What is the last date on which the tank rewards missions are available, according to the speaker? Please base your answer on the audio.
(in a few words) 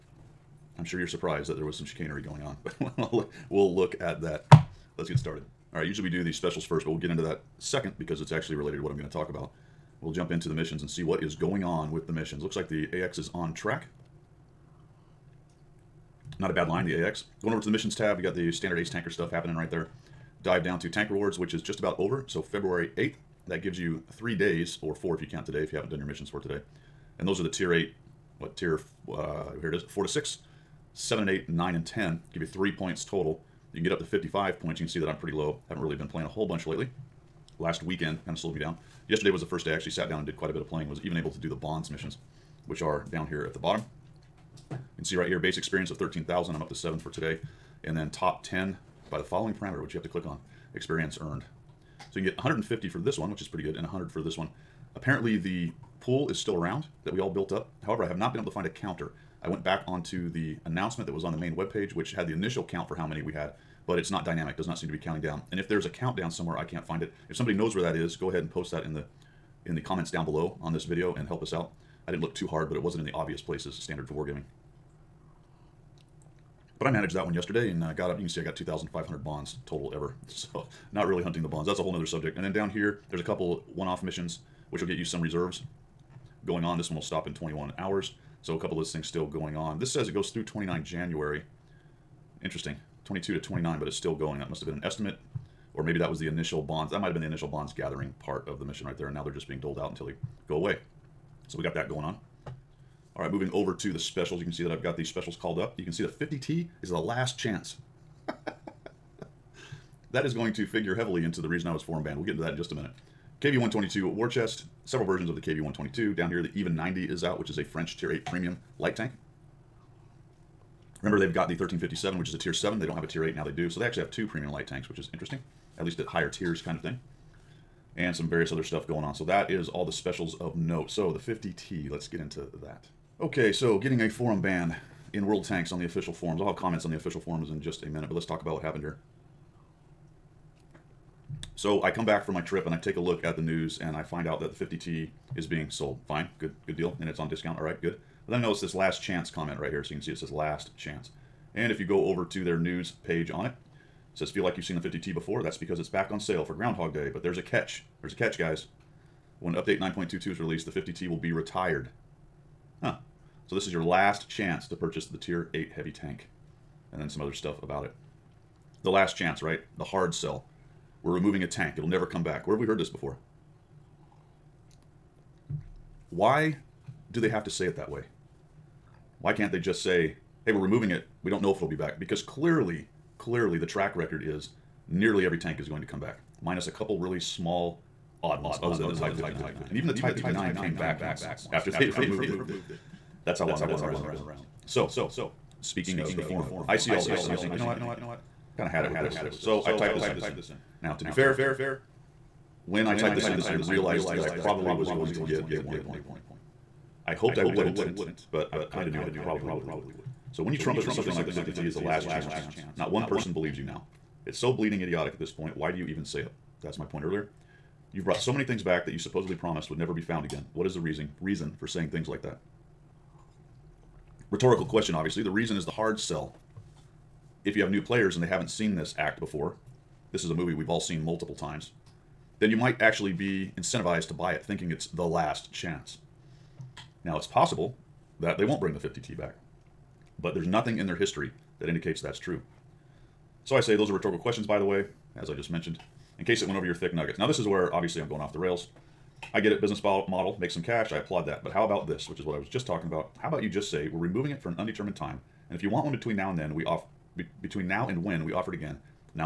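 February 8th.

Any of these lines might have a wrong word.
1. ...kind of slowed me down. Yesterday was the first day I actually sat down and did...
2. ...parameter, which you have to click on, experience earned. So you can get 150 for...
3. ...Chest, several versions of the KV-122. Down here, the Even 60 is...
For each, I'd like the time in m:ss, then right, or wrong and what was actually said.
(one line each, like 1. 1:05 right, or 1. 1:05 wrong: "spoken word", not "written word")
1. 0:38 right
2. 0:49 right
3. 1:54 wrong: "90", not "60".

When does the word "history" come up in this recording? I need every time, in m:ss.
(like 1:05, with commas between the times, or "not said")
4:00.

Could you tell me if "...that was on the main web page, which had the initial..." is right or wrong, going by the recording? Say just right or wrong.
right.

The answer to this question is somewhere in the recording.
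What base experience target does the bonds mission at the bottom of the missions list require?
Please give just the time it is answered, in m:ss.
0:45.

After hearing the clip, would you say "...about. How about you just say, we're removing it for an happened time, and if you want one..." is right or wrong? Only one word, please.
wrong.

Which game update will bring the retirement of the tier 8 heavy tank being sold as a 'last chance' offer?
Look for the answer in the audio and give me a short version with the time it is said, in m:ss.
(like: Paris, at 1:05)
9.22, at 2:39.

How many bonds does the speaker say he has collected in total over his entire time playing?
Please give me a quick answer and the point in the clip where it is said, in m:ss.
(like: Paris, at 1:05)
2,500, at 1:18.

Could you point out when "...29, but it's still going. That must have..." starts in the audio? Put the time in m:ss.
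1:33.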